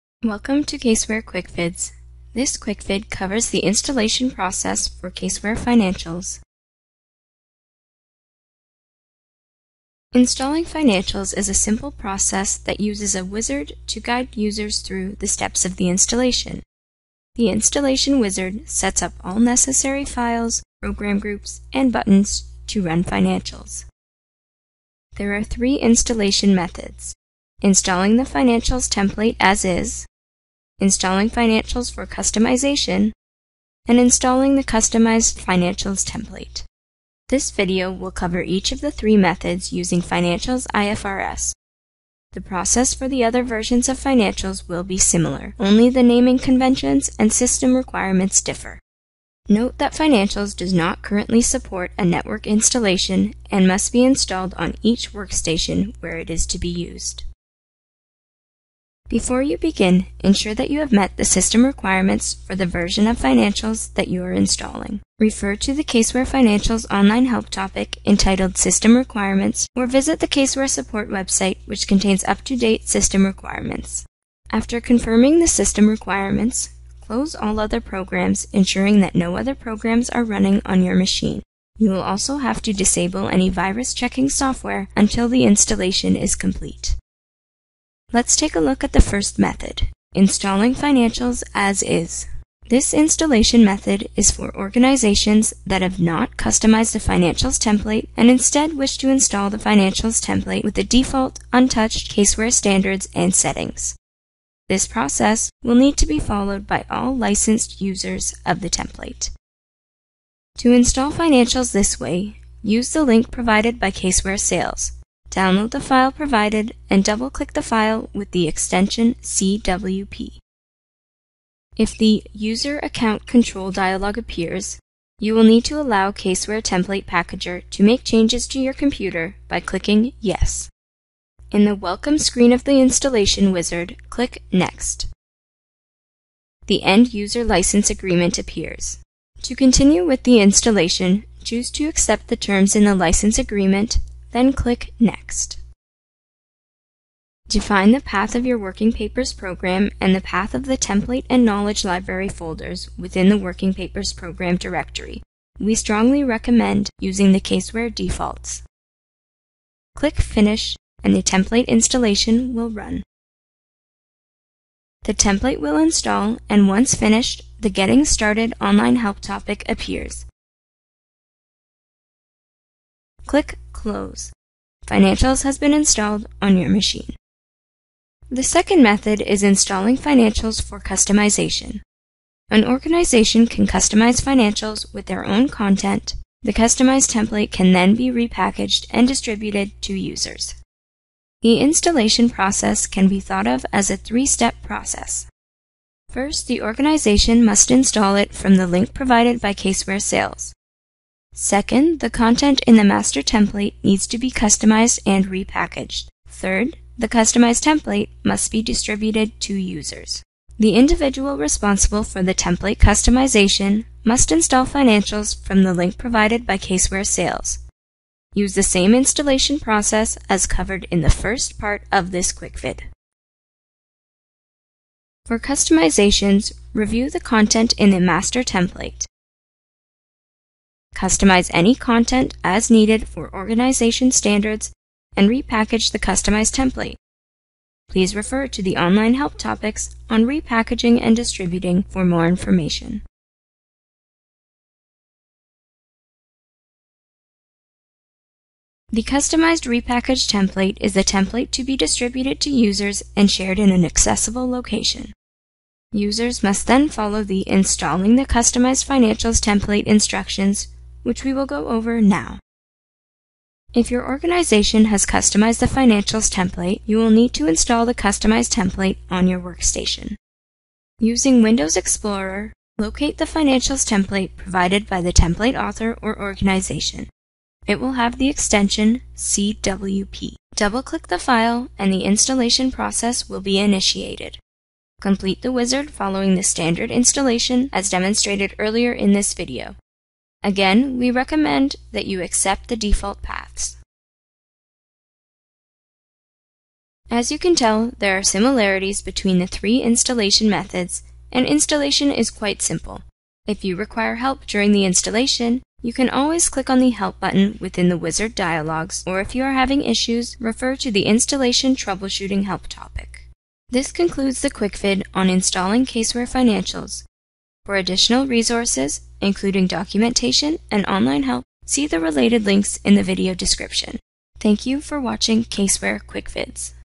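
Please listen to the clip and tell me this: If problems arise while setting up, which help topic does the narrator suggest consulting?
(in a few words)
Installation Troubleshooting.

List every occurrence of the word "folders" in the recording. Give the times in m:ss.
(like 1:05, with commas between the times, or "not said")
2:32.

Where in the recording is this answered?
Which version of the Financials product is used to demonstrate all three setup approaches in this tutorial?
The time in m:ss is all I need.
0:40.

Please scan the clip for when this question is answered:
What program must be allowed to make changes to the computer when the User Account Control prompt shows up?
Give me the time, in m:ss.
2:06.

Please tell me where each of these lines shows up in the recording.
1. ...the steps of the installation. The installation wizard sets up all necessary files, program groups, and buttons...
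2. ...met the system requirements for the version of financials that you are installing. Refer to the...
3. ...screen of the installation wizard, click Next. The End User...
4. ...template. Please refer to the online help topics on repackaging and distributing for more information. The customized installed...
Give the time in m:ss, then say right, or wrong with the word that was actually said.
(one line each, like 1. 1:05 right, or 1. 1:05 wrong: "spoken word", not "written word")
1. 0:15 right
2. 1:00 right
3. 2:12 right
4. 3:56 wrong: "repackaged", not "installed".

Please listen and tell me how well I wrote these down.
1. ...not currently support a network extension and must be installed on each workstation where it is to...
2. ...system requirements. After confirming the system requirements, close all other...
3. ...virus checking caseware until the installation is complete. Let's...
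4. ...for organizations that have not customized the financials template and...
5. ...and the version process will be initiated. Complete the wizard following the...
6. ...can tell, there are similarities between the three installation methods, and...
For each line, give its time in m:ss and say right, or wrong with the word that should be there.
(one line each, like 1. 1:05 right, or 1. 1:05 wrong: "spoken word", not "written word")
1. 0:50 wrong: "installation", not "extension"
2. 1:12 right
3. 1:23 wrong: "software", not "caseware"
4. 1:34 right
5. 4:41 wrong: "installation", not "version"
6. 4:57 right.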